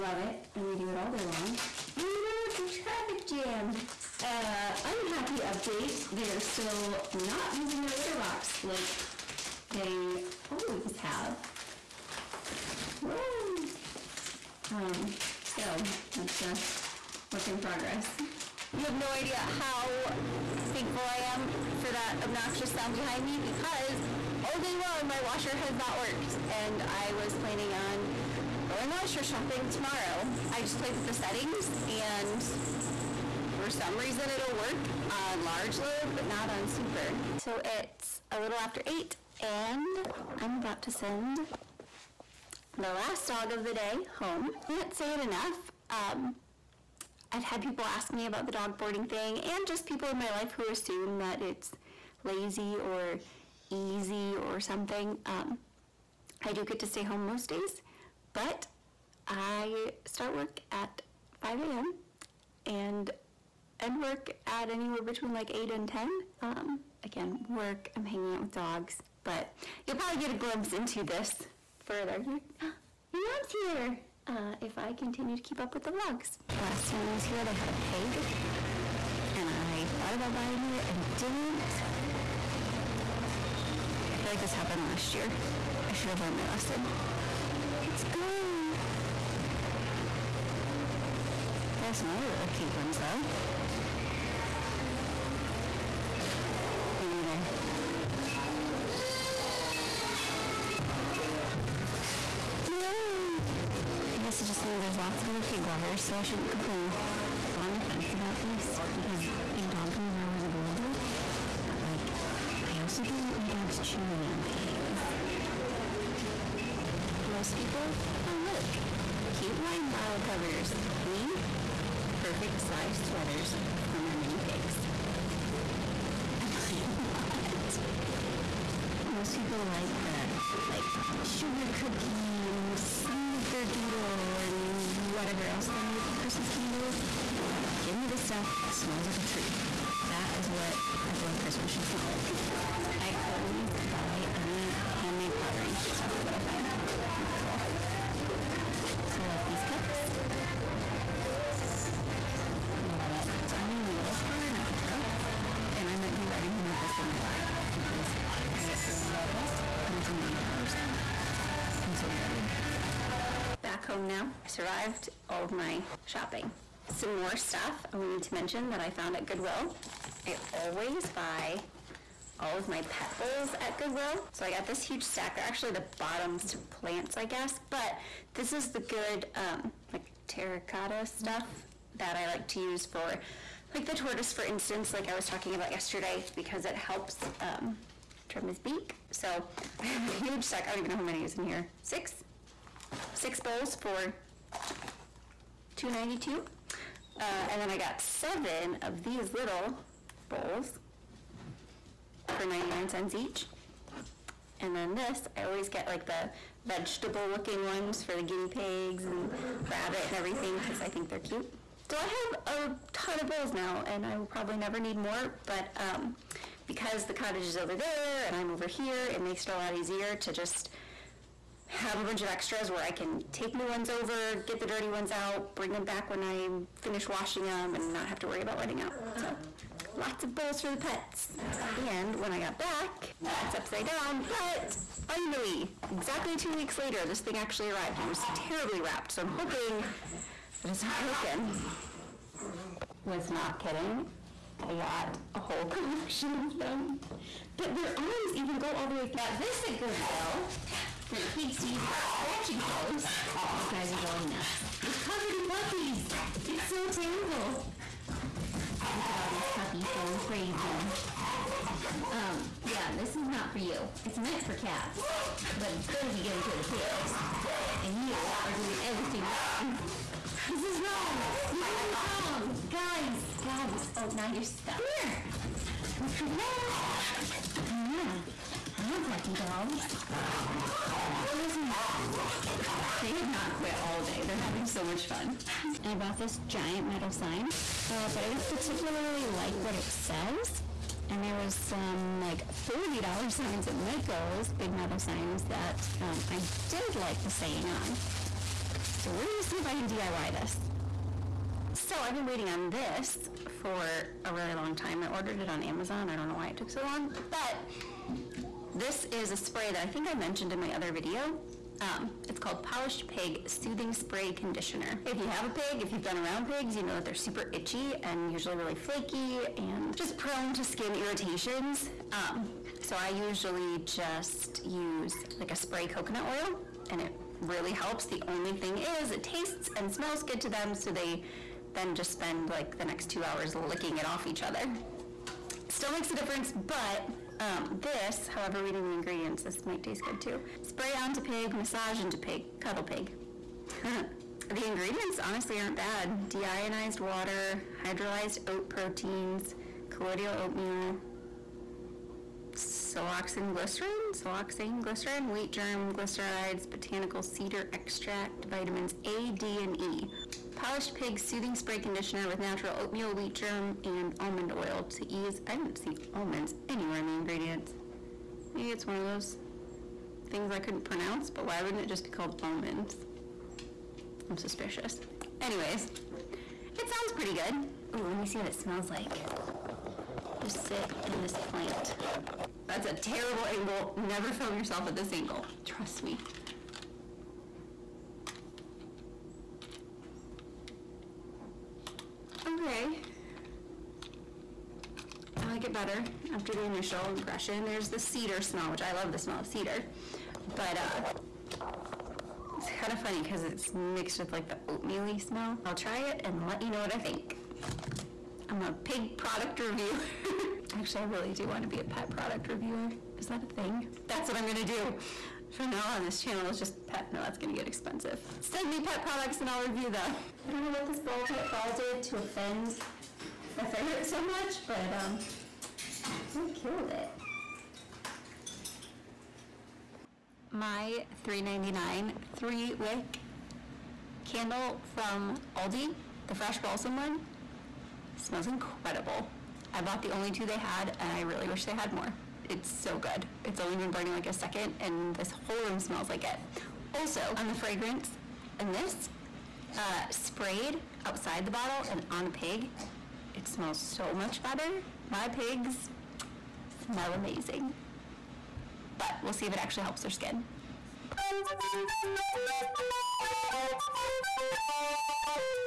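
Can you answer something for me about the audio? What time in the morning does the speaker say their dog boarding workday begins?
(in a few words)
5 a.m.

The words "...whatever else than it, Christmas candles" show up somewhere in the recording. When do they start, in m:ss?
2:15.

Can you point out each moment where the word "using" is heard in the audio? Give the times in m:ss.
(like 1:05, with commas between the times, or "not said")
0:07, 4:11.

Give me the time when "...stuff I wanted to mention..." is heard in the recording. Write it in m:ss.
2:47.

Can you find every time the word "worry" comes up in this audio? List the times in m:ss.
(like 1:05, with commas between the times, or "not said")
3:48.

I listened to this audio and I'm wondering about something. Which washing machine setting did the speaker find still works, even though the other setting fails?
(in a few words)
Large load.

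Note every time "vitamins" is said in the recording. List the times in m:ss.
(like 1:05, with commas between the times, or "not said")
5:58.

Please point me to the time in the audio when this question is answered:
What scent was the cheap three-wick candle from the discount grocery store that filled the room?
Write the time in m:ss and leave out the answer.
7:16.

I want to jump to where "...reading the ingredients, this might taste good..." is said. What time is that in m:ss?
5:38.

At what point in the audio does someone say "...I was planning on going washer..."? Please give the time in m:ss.
0:26.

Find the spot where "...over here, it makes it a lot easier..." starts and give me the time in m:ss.
3:38.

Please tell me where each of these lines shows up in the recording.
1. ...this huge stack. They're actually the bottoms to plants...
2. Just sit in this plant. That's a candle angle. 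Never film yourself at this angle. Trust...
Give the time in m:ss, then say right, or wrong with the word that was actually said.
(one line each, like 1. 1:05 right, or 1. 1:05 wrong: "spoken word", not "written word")
1. 2:54 right
2. 6:20 wrong: "terrible", not "candle".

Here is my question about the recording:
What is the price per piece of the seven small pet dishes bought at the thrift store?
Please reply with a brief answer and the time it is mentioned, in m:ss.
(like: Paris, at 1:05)
99 cents, at 3:22.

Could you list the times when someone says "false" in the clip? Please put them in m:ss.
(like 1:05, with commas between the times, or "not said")
not said.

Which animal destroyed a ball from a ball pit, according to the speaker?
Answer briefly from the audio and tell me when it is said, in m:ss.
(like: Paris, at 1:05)
Ferret, at 7:03.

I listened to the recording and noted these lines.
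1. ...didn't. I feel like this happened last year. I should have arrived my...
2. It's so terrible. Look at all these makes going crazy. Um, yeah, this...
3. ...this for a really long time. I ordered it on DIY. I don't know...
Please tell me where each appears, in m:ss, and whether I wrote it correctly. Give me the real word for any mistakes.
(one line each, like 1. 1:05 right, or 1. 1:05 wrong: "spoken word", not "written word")
1. 1:21 wrong: "learned", not "arrived"
2. 4:16 wrong: "puppies", not "makes"
3. 5:02 wrong: "Amazon", not "DIY".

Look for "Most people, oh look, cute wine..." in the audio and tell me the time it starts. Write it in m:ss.
1:57.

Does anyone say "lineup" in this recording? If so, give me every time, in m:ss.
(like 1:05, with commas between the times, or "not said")
not said.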